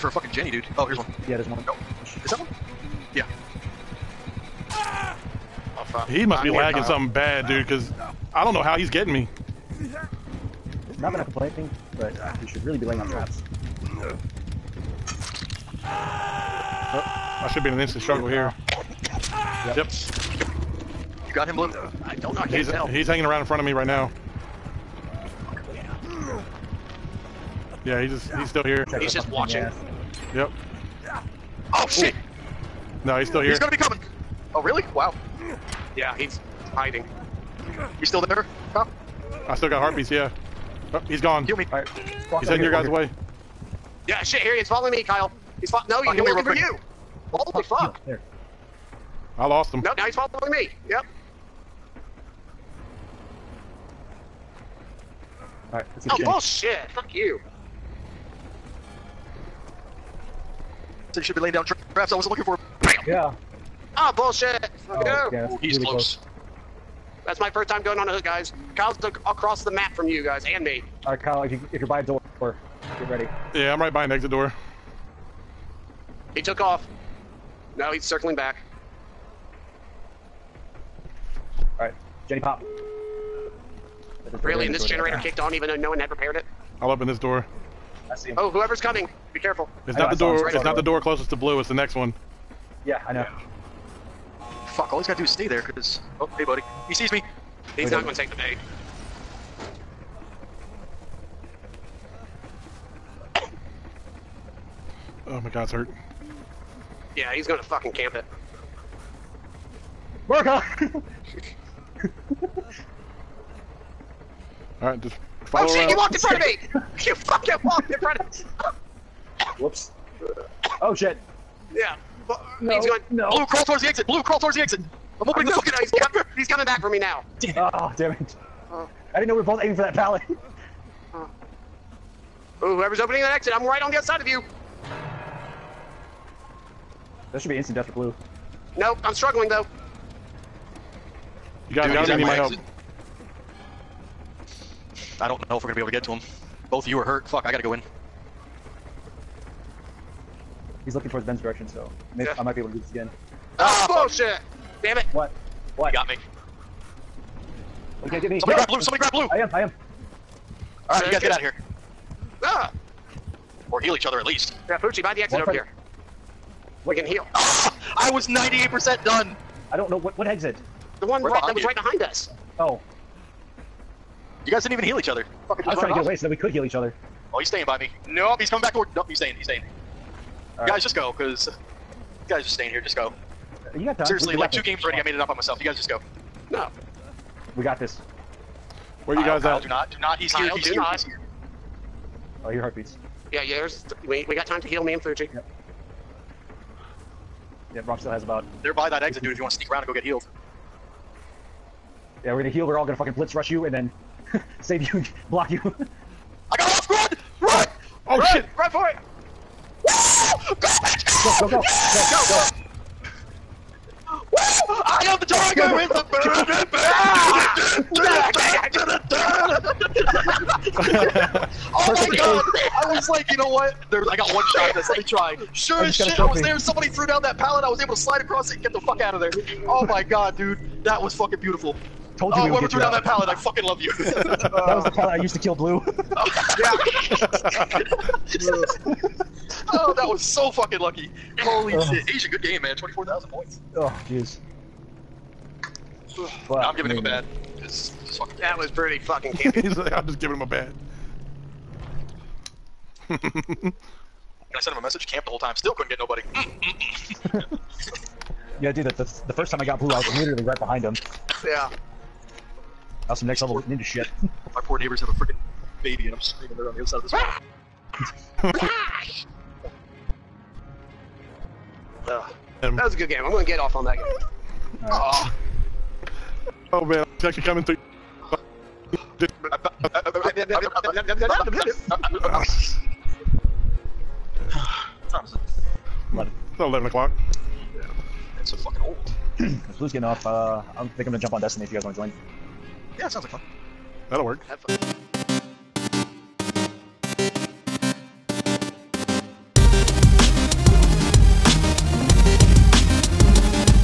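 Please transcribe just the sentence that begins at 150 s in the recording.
He's looking towards Ben's direction, so maybe yeah.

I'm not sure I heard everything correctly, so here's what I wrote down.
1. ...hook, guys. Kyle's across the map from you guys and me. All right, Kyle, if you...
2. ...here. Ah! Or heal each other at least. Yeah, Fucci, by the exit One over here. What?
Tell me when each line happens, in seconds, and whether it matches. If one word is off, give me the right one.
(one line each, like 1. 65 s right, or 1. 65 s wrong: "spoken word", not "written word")
1. 68 s right
2. 161 s right.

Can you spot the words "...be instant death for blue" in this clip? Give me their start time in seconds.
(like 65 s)
137 s.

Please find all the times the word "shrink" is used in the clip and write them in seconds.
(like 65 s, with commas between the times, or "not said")
not said.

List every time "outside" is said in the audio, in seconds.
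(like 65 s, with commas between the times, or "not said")
133 s.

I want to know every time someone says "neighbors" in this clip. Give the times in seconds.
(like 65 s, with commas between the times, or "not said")
264 s.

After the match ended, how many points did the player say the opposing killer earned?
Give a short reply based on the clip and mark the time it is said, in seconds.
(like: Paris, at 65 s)
24,000, at 242 s.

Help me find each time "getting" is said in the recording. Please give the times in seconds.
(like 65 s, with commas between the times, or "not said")
8 s, 289 s.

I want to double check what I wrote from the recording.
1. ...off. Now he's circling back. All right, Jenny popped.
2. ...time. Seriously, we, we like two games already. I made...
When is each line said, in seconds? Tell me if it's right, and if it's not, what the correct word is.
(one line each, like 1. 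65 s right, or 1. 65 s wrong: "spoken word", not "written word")
1. 76 s right
2. 183 s right.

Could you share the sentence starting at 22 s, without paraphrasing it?
He's hanging around in front of me right now.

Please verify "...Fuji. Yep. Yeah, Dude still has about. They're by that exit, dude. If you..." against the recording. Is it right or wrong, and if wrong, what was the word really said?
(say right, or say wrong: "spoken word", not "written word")
wrong: "Bronx", not "Dude".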